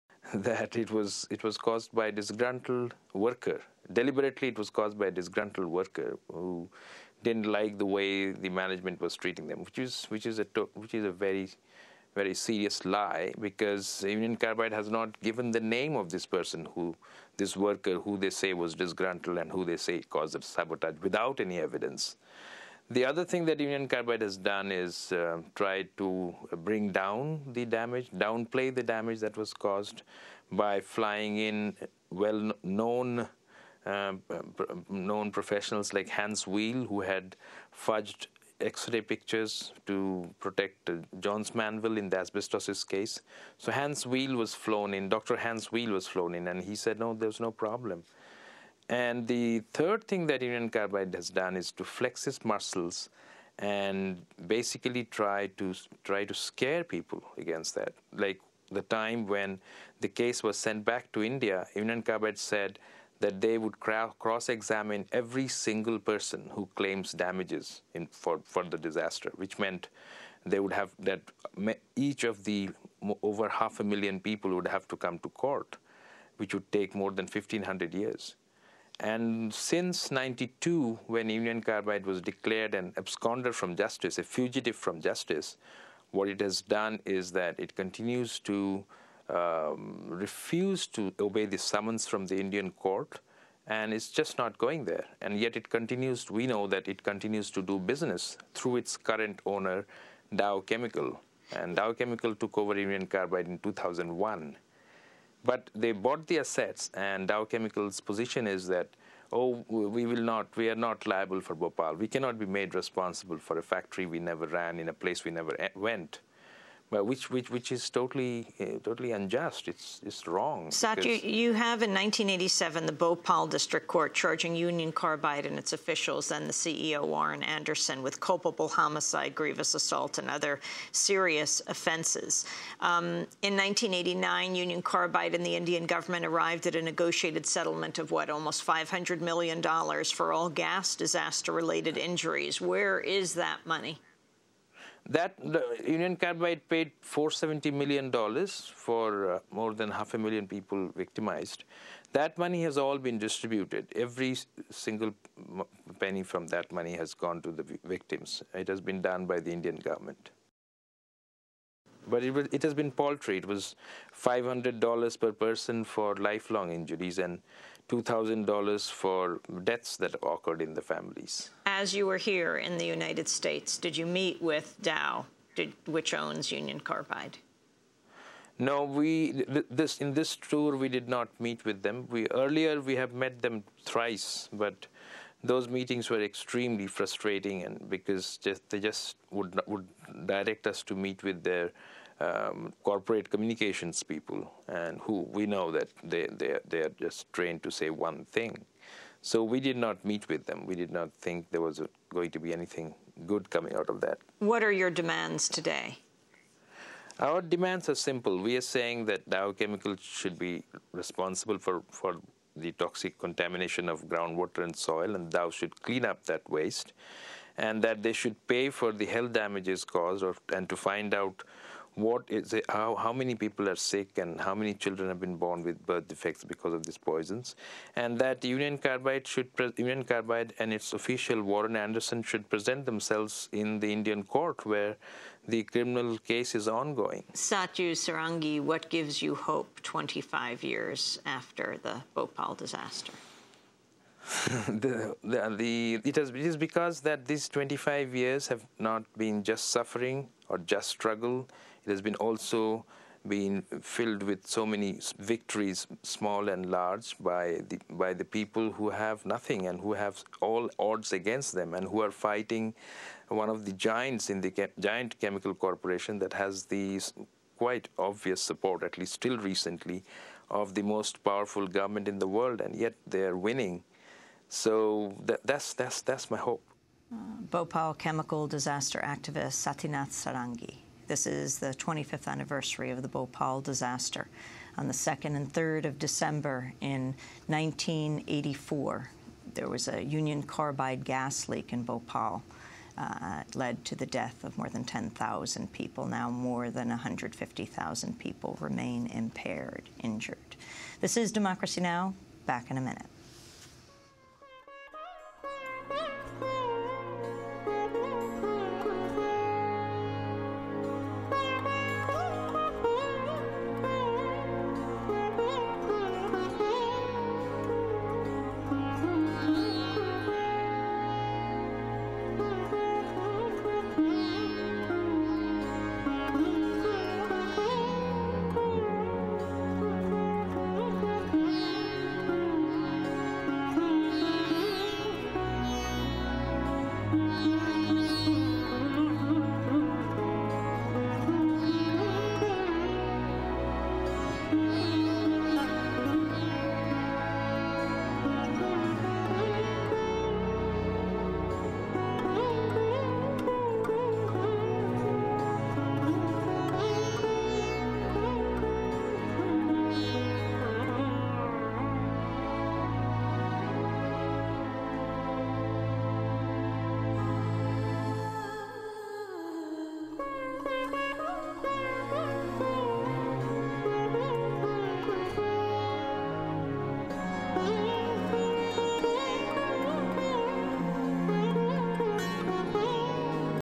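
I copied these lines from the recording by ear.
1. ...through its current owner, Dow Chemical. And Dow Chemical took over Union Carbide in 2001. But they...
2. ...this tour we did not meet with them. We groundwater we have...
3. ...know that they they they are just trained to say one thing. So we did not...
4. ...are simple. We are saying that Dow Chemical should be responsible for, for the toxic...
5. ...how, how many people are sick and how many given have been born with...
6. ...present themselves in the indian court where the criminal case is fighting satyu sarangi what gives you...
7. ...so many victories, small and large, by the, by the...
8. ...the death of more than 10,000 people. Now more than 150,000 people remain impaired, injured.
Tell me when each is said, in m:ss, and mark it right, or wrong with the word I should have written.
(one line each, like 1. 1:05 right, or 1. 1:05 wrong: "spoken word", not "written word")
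1. 1:38 right
2. 3:00 wrong: "earlier", not "groundwater"
3. 3:15 right
4. 3:27 right
5. 3:42 wrong: "children", not "given"
6. 3:52 wrong: "ongoing", not "fighting"
7. 4:14 right
8. 4:53 right.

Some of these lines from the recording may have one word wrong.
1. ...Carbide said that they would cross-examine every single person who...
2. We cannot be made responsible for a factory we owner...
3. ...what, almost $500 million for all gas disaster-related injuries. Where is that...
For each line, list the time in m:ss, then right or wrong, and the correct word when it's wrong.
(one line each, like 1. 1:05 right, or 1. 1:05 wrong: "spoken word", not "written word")
1. 1:02 right
2. 1:51 wrong: "never", not "owner"
3. 2:18 right.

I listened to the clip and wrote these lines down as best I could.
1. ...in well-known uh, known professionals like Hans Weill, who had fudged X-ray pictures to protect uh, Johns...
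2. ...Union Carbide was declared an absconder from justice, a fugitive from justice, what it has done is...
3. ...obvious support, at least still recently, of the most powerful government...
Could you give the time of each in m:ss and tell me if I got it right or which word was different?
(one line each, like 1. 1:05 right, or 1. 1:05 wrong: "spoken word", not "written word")
1. 0:31 right
2. 1:21 right
3. 4:27 right.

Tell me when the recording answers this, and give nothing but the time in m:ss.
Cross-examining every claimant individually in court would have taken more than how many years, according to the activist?
1:17.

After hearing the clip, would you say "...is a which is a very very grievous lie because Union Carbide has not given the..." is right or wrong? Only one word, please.
wrong.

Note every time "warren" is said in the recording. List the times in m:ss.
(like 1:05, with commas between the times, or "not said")
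2:07, 3:51.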